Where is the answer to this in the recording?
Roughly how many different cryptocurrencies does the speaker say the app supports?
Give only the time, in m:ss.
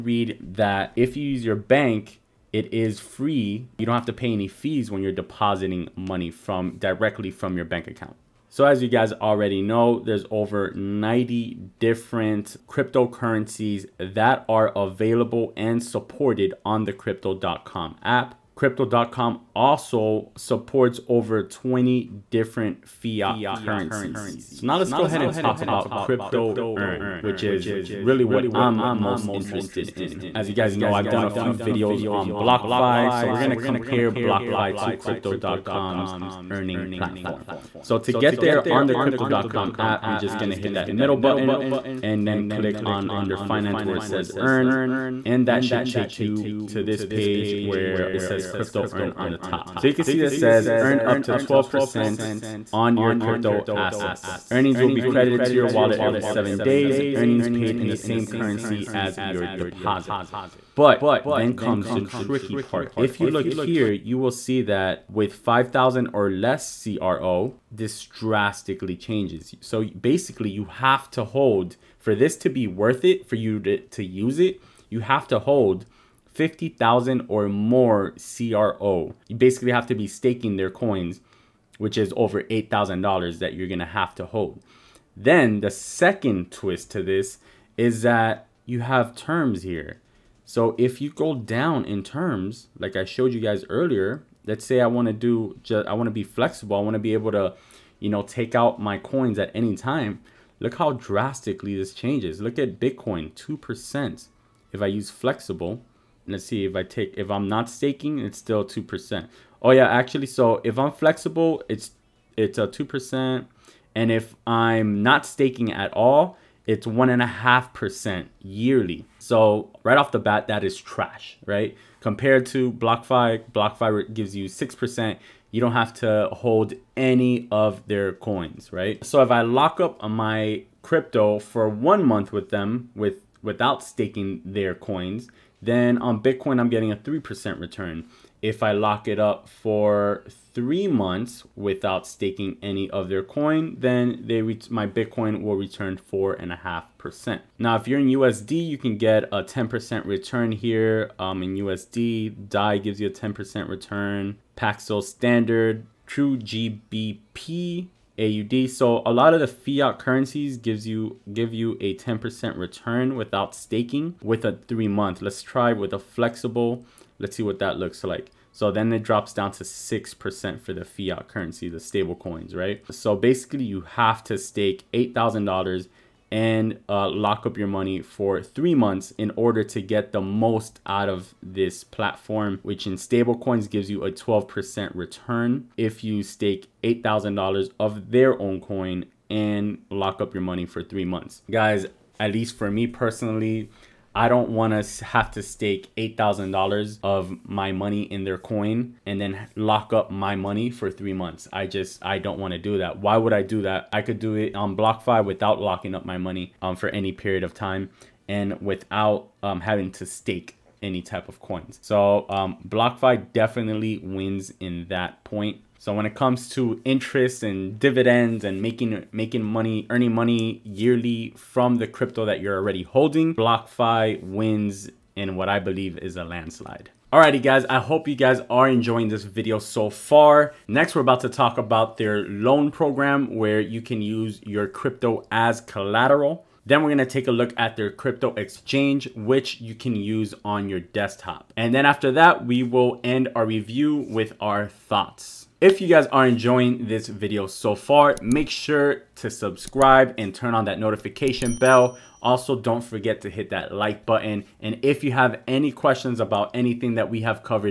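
0:10.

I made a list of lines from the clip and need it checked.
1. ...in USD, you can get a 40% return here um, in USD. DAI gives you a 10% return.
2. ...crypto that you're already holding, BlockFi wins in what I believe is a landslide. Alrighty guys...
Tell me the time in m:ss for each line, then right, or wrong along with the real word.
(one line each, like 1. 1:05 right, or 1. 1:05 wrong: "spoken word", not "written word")
1. 2:27 wrong: "10", not "40"
2. 3:41 right.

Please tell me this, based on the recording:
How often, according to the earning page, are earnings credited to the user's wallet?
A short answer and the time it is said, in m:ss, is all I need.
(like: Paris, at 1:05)
every 7 days, at 0:55.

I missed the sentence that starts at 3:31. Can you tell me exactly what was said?
So um, BlockFi definitely wins in that point.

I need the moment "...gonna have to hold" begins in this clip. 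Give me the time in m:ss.
1:23.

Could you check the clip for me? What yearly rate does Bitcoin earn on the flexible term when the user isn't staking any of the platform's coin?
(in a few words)
1.5%.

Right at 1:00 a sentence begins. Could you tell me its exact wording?
But then comes the tricky part.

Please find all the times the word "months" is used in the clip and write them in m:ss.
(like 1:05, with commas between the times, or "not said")
2:12, 2:20, 2:44, 2:58, 3:11, 3:21.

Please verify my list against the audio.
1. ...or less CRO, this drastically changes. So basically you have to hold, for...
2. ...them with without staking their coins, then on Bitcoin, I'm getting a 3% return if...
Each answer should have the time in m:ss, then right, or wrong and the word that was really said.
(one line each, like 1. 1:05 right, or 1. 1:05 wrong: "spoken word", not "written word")
1. 1:06 right
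2. 2:12 right.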